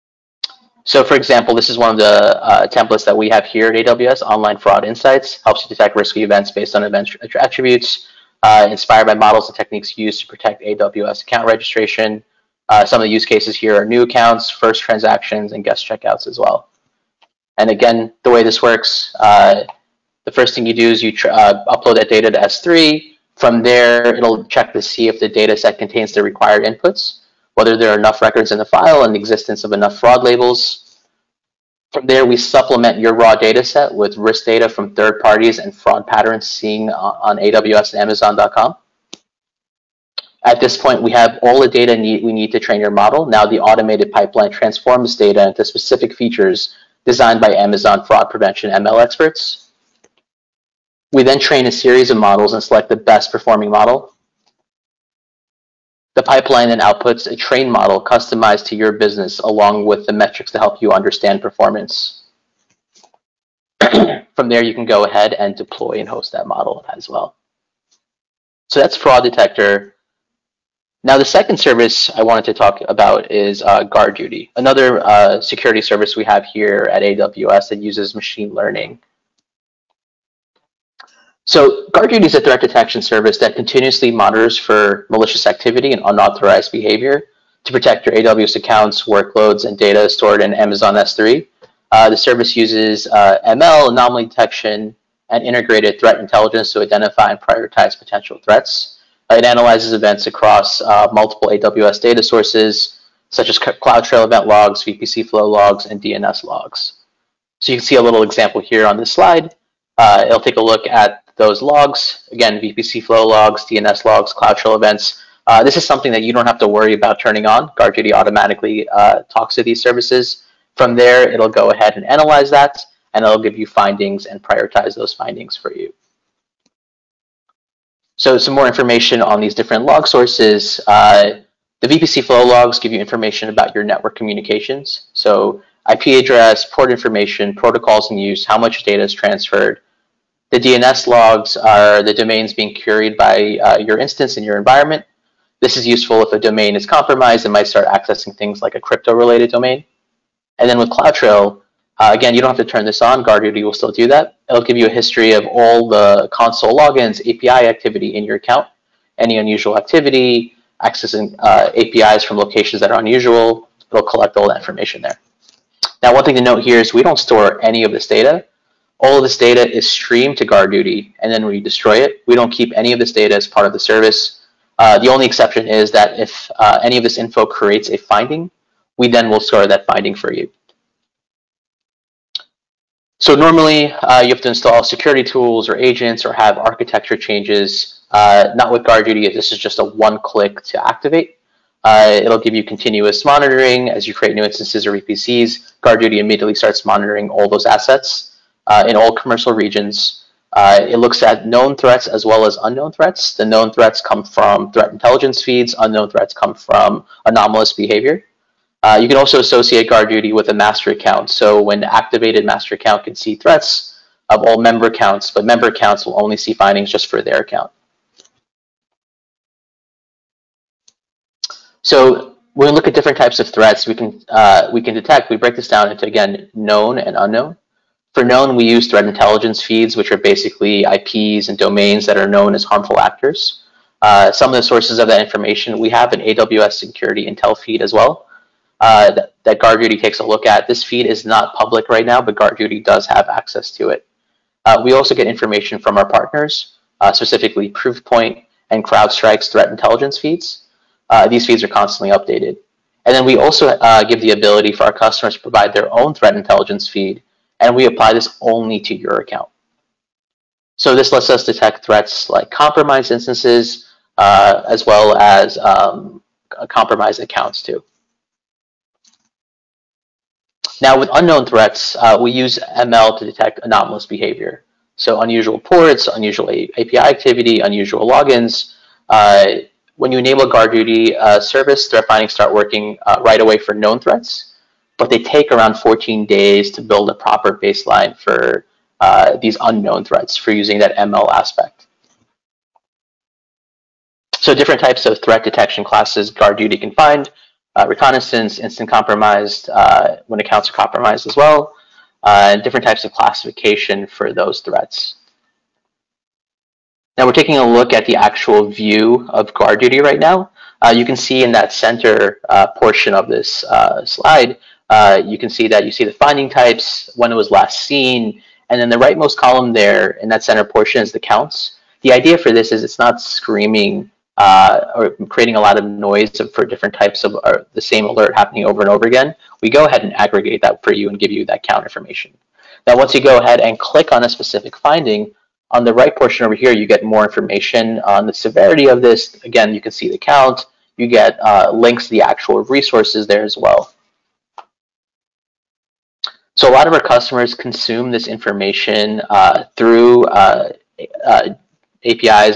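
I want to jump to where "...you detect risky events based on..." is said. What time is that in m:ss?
0:05.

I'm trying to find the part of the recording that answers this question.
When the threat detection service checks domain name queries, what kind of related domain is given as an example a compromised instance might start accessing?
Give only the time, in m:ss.
2:28.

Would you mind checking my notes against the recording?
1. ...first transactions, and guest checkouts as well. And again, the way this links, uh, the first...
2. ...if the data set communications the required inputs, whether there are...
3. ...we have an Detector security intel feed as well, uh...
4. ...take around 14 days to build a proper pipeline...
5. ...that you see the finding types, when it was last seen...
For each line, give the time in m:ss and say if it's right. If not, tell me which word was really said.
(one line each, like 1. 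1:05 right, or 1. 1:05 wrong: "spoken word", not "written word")
1. 0:14 wrong: "works", not "links"
2. 0:25 wrong: "contains", not "communications"
3. 3:55 wrong: "AWS", not "Detector"
4. 4:45 wrong: "baseline", not "pipeline"
5. 5:15 right.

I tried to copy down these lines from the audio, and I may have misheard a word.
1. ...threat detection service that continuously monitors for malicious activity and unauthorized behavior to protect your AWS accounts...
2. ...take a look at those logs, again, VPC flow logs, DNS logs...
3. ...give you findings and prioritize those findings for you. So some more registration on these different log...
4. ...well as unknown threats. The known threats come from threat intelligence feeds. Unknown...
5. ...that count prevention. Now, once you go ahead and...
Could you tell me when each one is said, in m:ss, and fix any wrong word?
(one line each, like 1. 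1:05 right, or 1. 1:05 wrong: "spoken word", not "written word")
1. 1:22 right
2. 1:50 right
3. 2:03 wrong: "information", not "registration"
4. 3:22 right
5. 5:31 wrong: "information", not "prevention".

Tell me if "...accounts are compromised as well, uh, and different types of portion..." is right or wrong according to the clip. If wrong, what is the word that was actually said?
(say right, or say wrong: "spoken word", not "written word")
wrong: "classification", not "portion".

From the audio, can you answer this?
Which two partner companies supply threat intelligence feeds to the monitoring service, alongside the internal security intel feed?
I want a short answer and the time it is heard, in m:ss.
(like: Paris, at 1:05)
Proofpoint and CrowdStrike, at 4:07.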